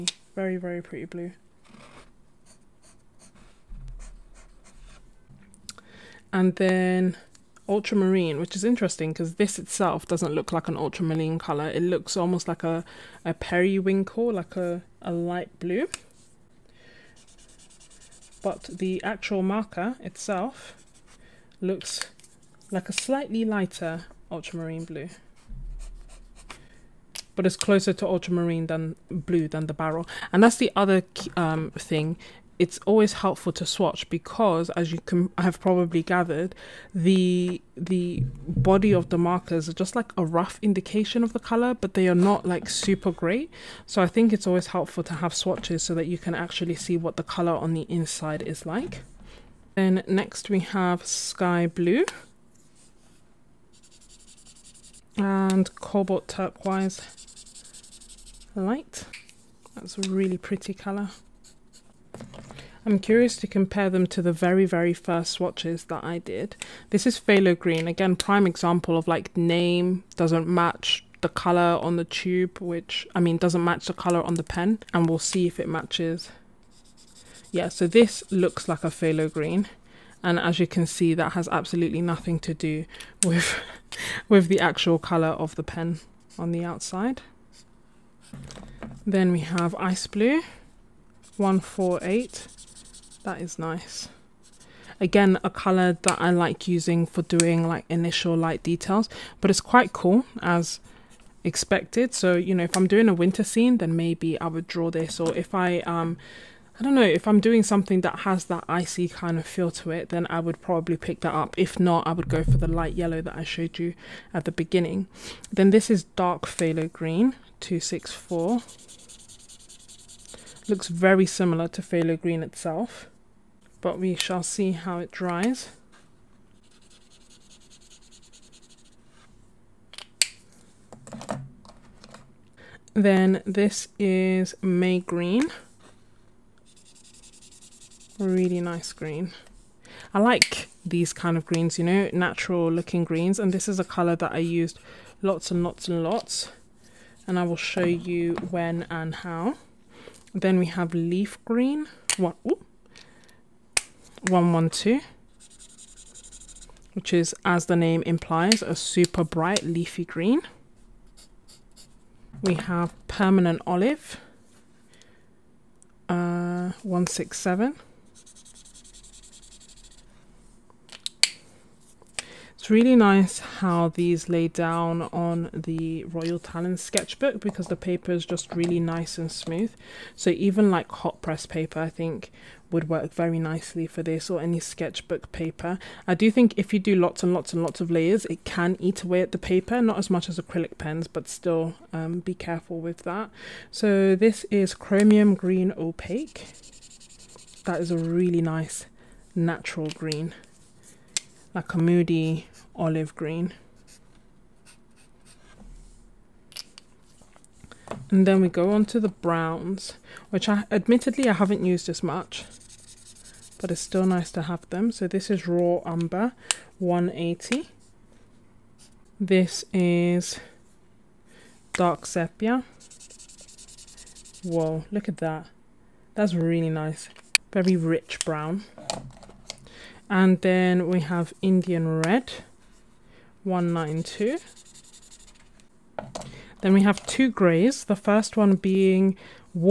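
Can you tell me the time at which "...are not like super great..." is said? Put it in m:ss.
0:42.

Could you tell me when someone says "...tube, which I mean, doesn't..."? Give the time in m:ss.
1:12.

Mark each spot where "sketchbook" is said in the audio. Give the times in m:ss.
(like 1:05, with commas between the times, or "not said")
2:56, 3:04.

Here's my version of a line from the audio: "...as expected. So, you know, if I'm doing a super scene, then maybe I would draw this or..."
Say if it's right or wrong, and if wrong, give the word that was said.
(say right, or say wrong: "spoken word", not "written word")
wrong: "winter", not "super".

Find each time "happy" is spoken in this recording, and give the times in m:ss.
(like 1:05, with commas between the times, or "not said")
not said.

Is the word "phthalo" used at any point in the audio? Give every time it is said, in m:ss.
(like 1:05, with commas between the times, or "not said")
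1:07, 1:18, 1:56, 2:01.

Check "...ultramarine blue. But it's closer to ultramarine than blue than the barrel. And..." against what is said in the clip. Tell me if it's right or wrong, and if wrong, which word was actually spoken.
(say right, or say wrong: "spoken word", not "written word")
right.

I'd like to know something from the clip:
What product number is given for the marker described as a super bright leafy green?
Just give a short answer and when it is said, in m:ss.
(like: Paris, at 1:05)
112, at 2:34.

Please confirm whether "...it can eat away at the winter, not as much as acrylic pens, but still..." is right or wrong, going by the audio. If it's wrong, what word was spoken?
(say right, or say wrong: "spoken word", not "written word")
wrong: "paper", not "winter".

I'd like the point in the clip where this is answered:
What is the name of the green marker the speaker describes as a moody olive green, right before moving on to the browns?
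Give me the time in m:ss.
3:14.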